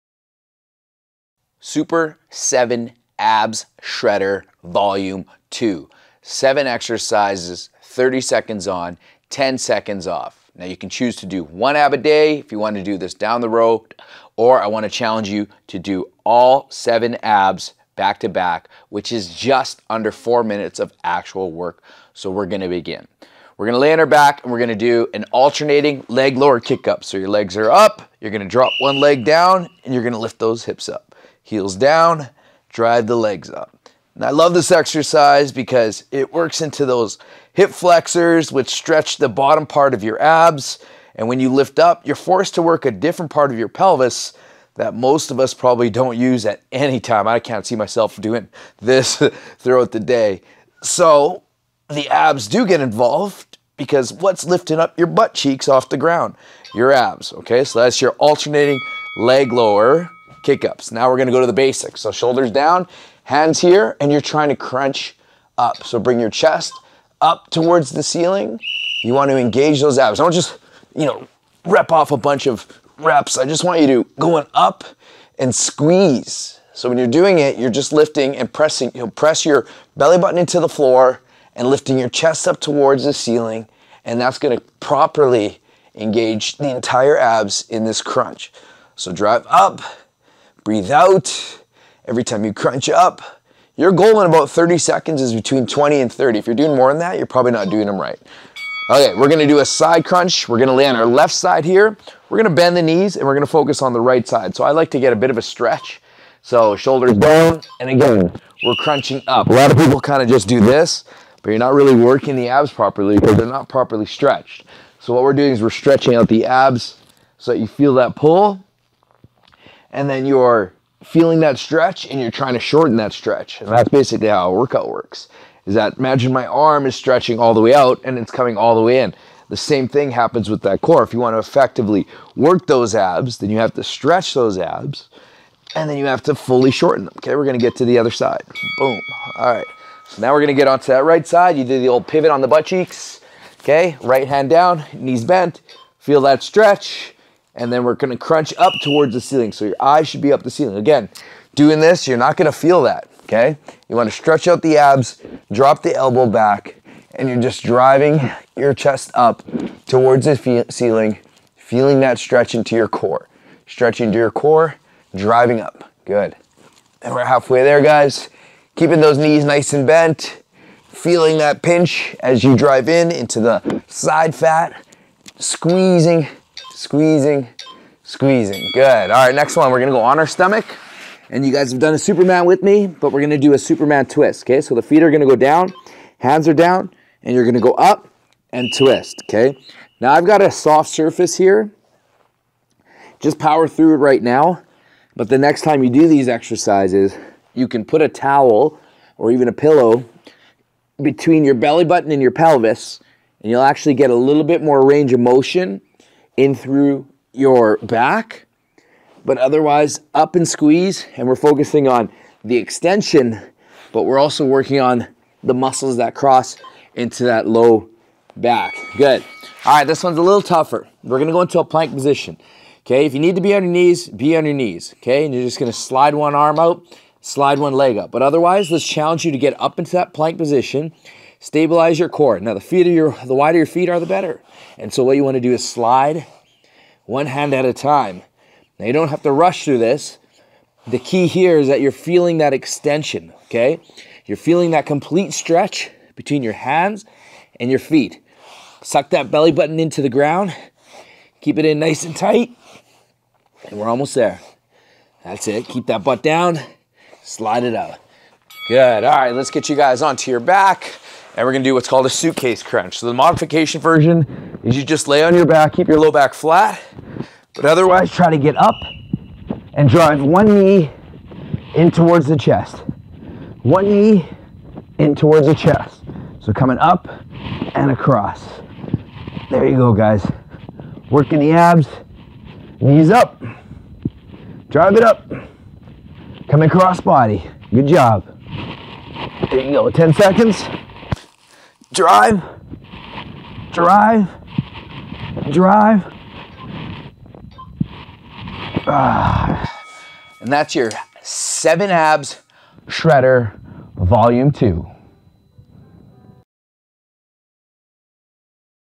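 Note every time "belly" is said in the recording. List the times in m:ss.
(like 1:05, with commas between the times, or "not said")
1:19, 3:21, 4:09.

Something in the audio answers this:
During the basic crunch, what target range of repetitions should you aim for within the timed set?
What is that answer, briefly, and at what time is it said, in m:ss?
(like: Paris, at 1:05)
20 to 30, at 1:35.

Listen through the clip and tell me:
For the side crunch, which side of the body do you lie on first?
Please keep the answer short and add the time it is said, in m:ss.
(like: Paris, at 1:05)
Left side, at 1:41.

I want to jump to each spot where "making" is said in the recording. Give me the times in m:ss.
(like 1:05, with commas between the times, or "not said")
not said.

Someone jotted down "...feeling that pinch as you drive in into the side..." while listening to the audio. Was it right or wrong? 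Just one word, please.
right.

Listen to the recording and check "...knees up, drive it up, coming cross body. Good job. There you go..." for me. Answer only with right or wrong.
right.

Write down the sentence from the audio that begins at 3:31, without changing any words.
And we're focusing on the extension, but we're also working on the muscles that cross into that low back.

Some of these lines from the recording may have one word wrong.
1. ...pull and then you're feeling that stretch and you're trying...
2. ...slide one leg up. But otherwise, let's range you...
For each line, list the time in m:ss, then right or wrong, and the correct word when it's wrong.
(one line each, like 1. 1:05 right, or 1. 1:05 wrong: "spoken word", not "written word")
1. 1:58 right
2. 3:47 wrong: "challenge", not "range".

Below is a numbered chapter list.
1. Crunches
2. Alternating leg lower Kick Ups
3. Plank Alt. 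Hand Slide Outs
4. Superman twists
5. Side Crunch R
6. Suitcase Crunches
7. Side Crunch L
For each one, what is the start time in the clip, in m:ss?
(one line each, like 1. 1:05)
1. 1:00
2. 0:23
3. 3:39
4. 2:59
5. 1:38
6. 4:19
7. 2:18.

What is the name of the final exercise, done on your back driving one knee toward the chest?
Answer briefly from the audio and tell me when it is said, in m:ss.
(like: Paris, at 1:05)
Suitcase crunch, at 4:22.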